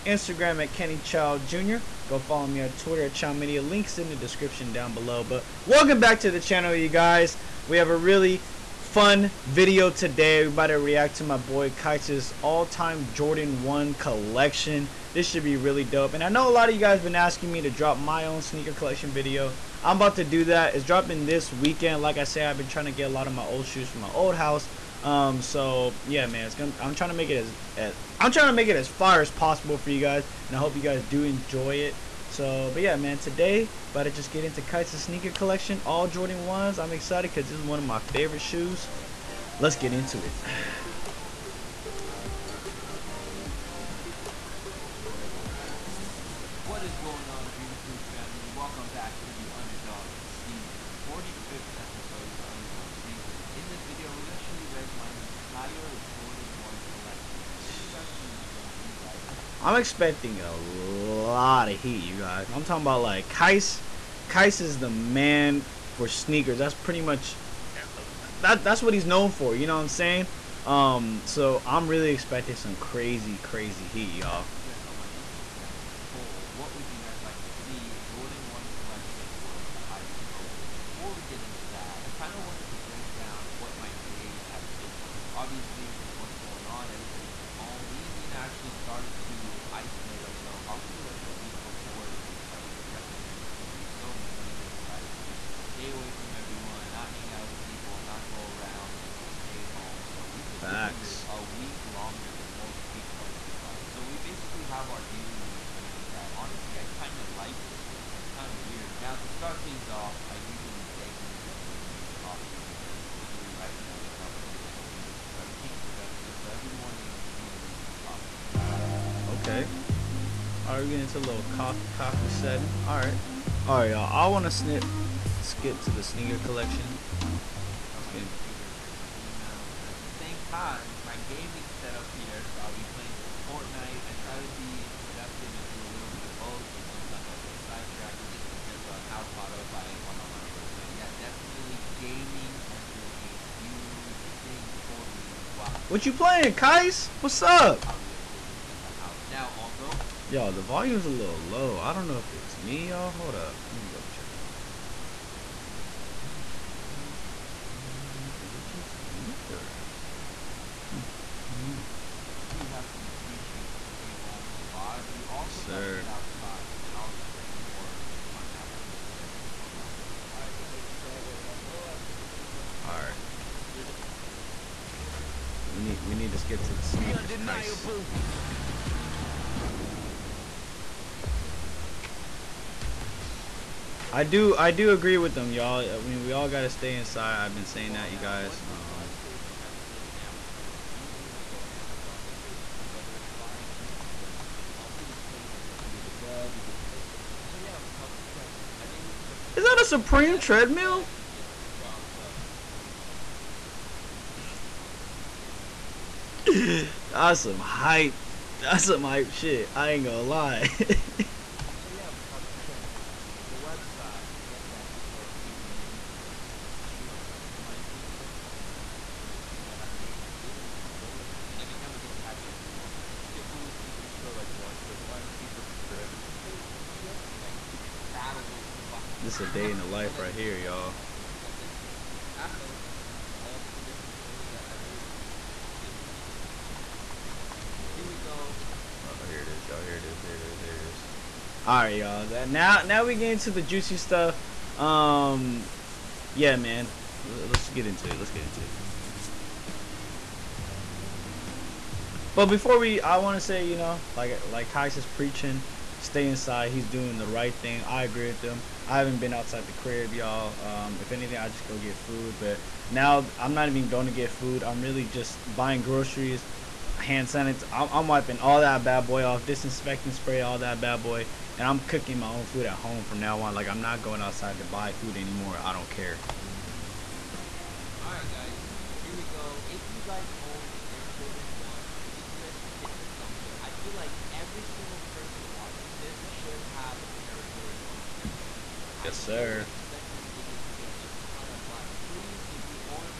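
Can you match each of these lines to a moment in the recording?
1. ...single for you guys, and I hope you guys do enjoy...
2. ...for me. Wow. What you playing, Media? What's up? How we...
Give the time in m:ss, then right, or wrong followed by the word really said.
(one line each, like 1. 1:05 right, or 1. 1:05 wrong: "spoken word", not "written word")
1. 0:29 wrong: "possible", not "single"
2. 2:24 wrong: "Qias", not "Media".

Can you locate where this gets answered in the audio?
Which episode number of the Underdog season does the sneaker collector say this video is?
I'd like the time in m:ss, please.
0:51.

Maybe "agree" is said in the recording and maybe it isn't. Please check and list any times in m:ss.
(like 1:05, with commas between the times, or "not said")
3:04, 4:18.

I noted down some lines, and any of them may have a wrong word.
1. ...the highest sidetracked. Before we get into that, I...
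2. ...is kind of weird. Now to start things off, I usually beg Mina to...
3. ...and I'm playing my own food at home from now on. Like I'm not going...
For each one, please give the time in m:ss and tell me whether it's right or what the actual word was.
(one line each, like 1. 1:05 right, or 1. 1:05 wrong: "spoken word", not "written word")
1. 1:19 wrong: "voted", not "sidetracked"
2. 1:48 right
3. 4:31 wrong: "cooking", not "playing".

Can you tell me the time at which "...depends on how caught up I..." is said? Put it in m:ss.
2:18.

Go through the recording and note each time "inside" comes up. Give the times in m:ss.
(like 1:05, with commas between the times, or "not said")
3:06, 4:16.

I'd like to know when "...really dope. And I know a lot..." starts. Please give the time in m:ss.
0:15.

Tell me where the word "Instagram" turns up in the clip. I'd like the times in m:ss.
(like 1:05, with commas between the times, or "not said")
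0:00, 1:15.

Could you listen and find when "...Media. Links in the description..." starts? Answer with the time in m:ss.
0:03.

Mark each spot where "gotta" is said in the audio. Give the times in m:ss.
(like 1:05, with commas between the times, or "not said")
2:45, 3:06.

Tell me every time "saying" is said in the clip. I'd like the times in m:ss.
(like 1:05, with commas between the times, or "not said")
1:09, 3:07.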